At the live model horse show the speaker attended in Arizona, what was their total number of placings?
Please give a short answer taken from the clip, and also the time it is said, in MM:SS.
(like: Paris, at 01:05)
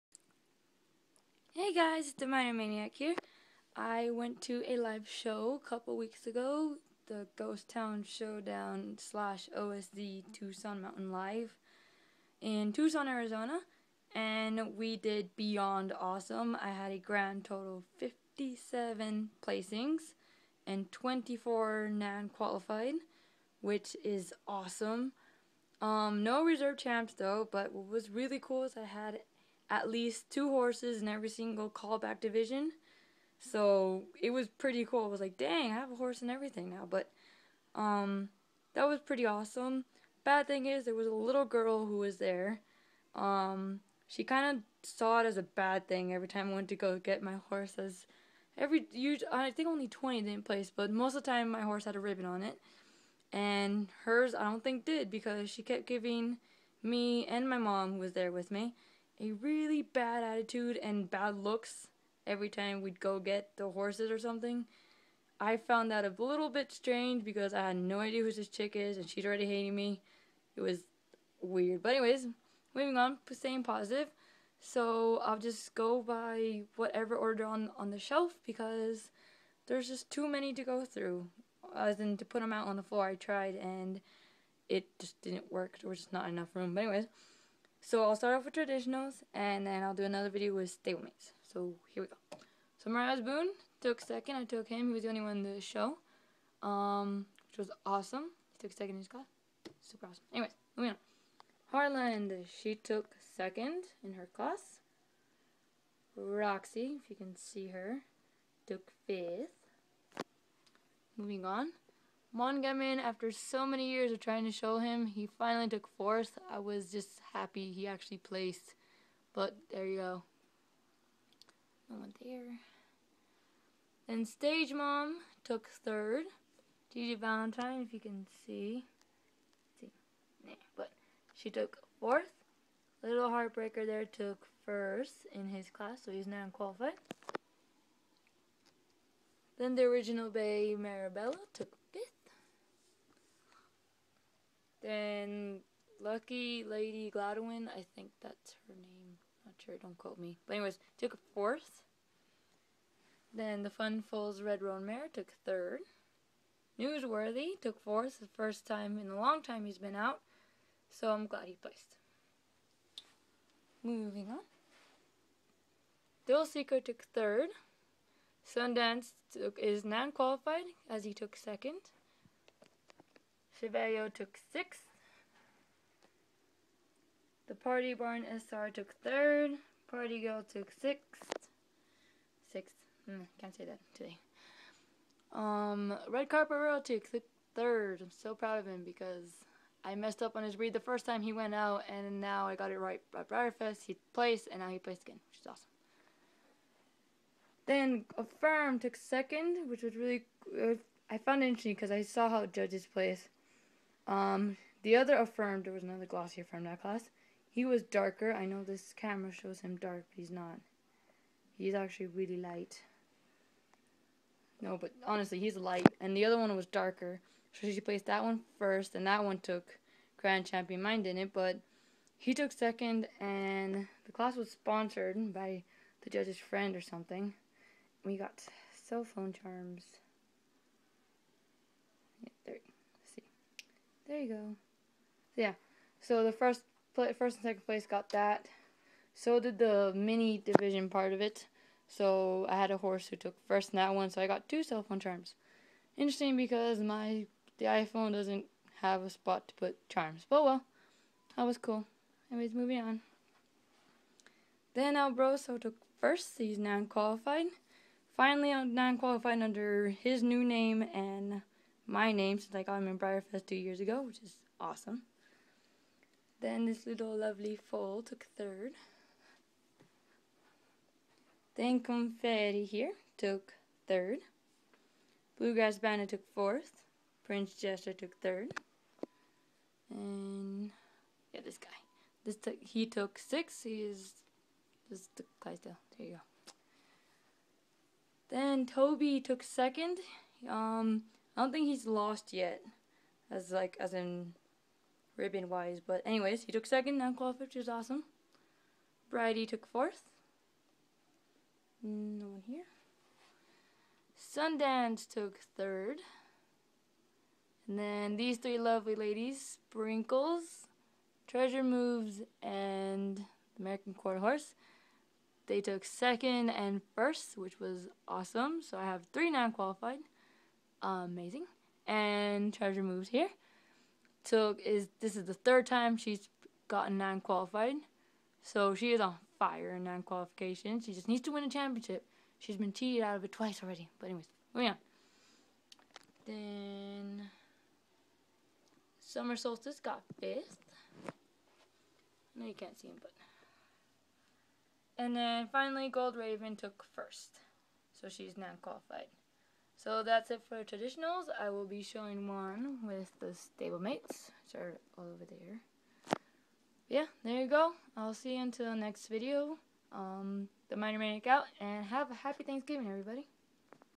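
57, at 00:17.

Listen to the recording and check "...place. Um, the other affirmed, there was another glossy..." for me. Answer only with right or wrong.
right.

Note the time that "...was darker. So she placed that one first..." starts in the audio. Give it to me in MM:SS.
03:36.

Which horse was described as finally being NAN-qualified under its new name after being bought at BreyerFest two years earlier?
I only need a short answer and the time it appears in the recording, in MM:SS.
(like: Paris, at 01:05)
Albroso, at 04:14.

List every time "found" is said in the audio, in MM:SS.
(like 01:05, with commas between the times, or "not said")
01:05, 03:21.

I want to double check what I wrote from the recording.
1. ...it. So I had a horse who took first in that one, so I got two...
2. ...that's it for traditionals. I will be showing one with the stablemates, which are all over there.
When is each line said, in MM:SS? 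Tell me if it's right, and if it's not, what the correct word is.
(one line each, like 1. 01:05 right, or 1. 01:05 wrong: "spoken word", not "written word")
1. 04:01 right
2. 05:50 right.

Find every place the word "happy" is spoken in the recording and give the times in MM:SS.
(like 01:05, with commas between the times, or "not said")
01:57, 06:02.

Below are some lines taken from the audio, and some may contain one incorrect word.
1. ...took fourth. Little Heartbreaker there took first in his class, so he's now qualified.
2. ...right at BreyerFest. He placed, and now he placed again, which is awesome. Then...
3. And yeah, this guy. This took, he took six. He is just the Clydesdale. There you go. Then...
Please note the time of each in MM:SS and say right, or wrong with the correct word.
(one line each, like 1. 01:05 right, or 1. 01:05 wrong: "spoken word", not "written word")
1. 02:11 right
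2. 03:12 right
3. 04:39 right.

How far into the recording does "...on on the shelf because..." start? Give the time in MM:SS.
01:17.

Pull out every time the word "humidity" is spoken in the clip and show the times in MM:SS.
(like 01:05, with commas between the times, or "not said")
not said.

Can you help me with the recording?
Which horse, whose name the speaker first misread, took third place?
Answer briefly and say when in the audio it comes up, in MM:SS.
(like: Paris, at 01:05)
Red Carpet Royal, at 03:06.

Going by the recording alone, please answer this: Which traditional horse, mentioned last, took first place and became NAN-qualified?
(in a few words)
Gold Raven.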